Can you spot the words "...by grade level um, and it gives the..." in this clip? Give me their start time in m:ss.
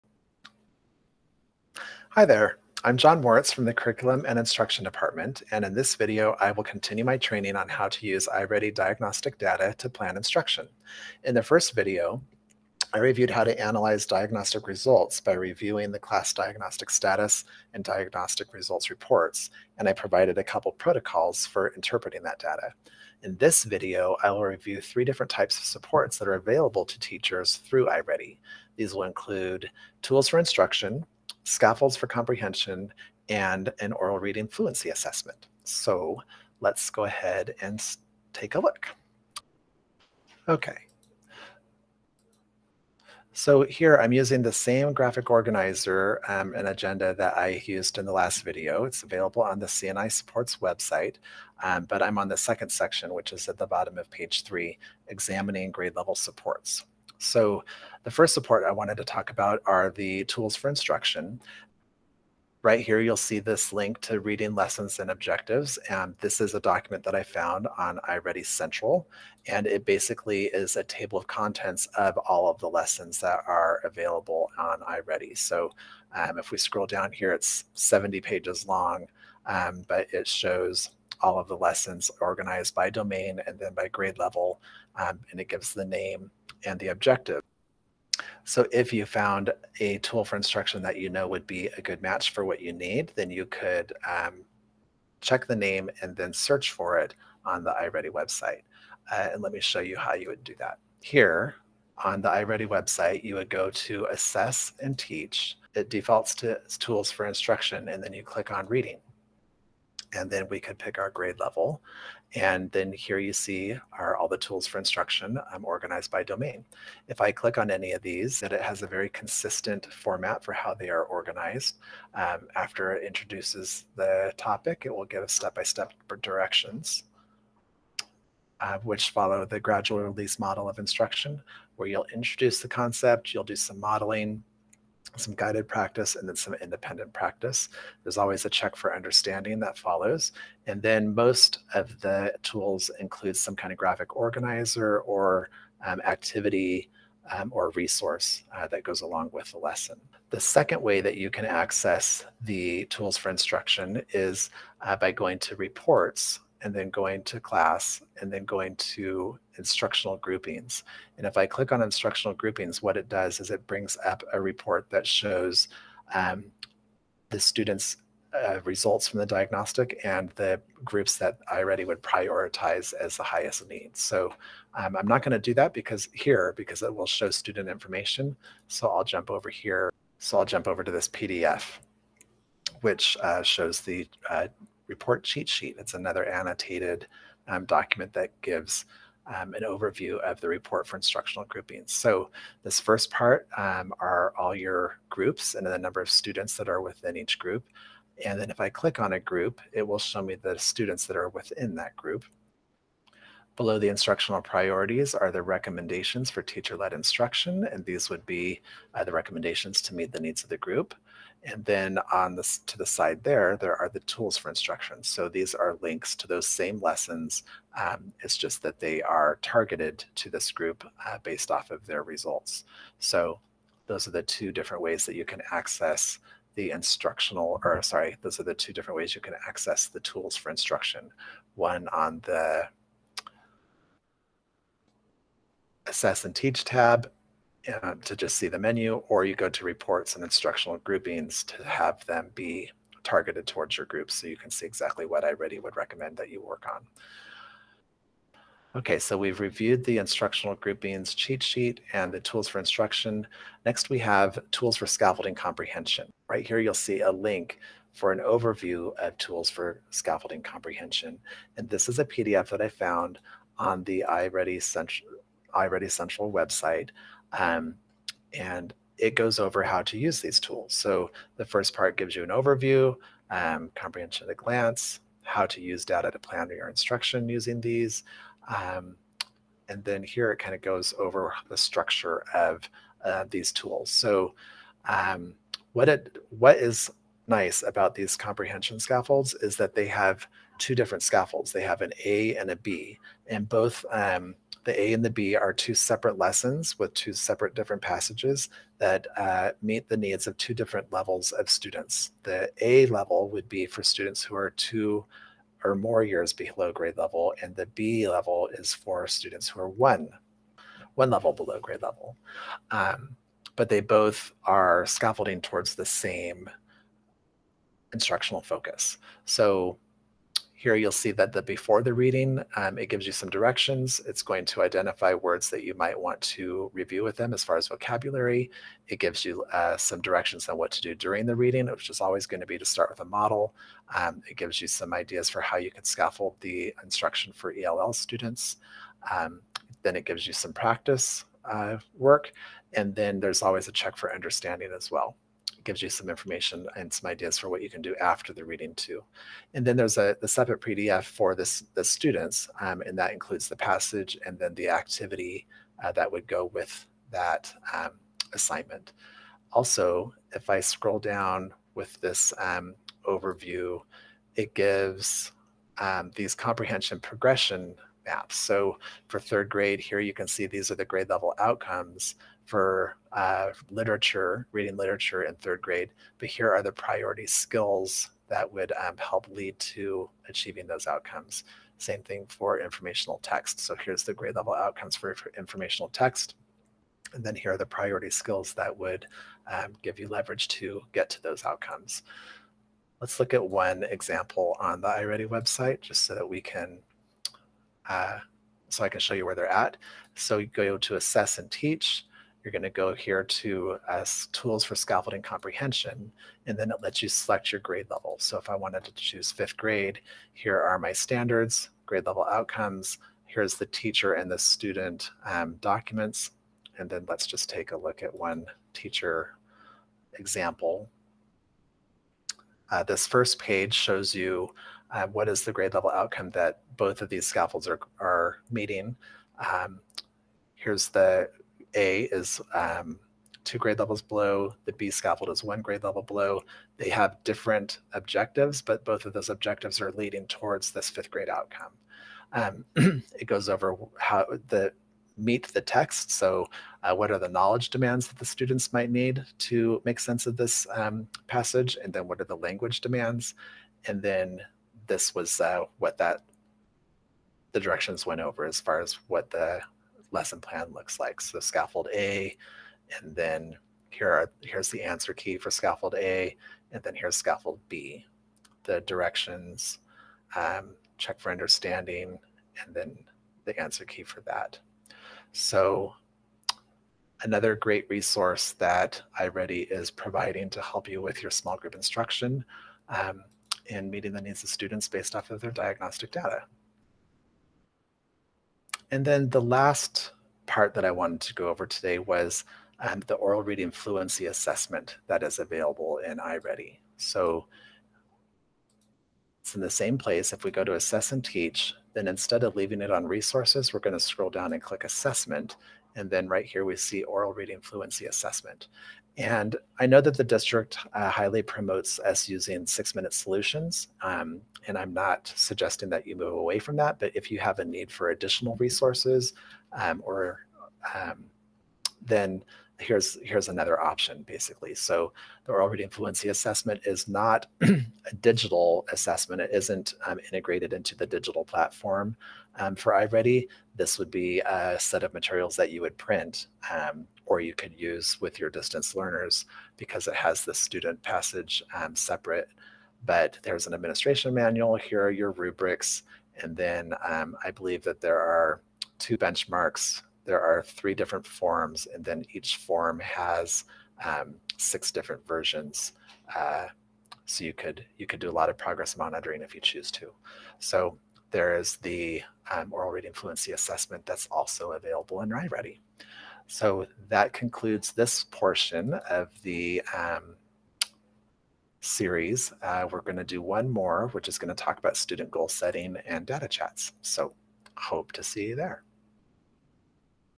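1:23.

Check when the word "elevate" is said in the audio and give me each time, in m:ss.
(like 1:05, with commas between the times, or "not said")
not said.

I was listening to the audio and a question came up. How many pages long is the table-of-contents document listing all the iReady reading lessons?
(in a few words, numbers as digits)
70.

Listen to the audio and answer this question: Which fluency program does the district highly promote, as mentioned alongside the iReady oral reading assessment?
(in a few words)
Six Minute Solutions.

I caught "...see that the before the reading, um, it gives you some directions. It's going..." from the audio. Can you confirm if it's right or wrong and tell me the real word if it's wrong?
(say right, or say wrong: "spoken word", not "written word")
right.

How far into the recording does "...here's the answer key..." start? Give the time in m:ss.
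7:44.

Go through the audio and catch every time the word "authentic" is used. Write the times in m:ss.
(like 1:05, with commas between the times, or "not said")
not said.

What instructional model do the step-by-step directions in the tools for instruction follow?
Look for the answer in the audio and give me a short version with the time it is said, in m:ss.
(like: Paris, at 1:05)
gradual release model, at 2:09.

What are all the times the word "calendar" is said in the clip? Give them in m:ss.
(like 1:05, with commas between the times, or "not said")
not said.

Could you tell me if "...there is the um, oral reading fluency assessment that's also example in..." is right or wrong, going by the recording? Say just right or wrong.
wrong.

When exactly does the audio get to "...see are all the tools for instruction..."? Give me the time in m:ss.
1:53.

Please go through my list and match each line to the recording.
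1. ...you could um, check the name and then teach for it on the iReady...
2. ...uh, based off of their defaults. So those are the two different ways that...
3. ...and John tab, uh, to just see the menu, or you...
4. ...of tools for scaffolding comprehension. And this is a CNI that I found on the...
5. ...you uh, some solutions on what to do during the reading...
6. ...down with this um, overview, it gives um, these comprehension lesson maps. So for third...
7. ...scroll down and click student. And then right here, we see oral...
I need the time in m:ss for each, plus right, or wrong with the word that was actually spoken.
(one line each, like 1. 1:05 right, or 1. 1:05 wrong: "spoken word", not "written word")
1. 1:33 wrong: "search", not "teach"
2. 3:41 wrong: "results", not "defaults"
3. 3:56 wrong: "Teach", not "John"
4. 4:18 wrong: "PDF", not "CNI"
5. 5:29 wrong: "directions", not "solutions"
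6. 6:00 wrong: "progression", not "lesson"
7. 8:23 wrong: "assessment", not "student".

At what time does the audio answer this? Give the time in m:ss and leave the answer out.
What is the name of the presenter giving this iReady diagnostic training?
0:02.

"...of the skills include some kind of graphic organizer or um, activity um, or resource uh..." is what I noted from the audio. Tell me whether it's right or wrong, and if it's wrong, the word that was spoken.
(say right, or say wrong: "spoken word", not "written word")
wrong: "tools", not "skills".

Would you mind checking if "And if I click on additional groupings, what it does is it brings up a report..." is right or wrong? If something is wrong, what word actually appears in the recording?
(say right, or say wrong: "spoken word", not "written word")
wrong: "instructional", not "additional".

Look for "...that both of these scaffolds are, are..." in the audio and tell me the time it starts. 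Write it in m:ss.
7:06.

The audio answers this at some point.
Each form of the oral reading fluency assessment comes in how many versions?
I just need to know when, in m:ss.
9:14.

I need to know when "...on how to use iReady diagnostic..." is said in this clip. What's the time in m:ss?
0:07.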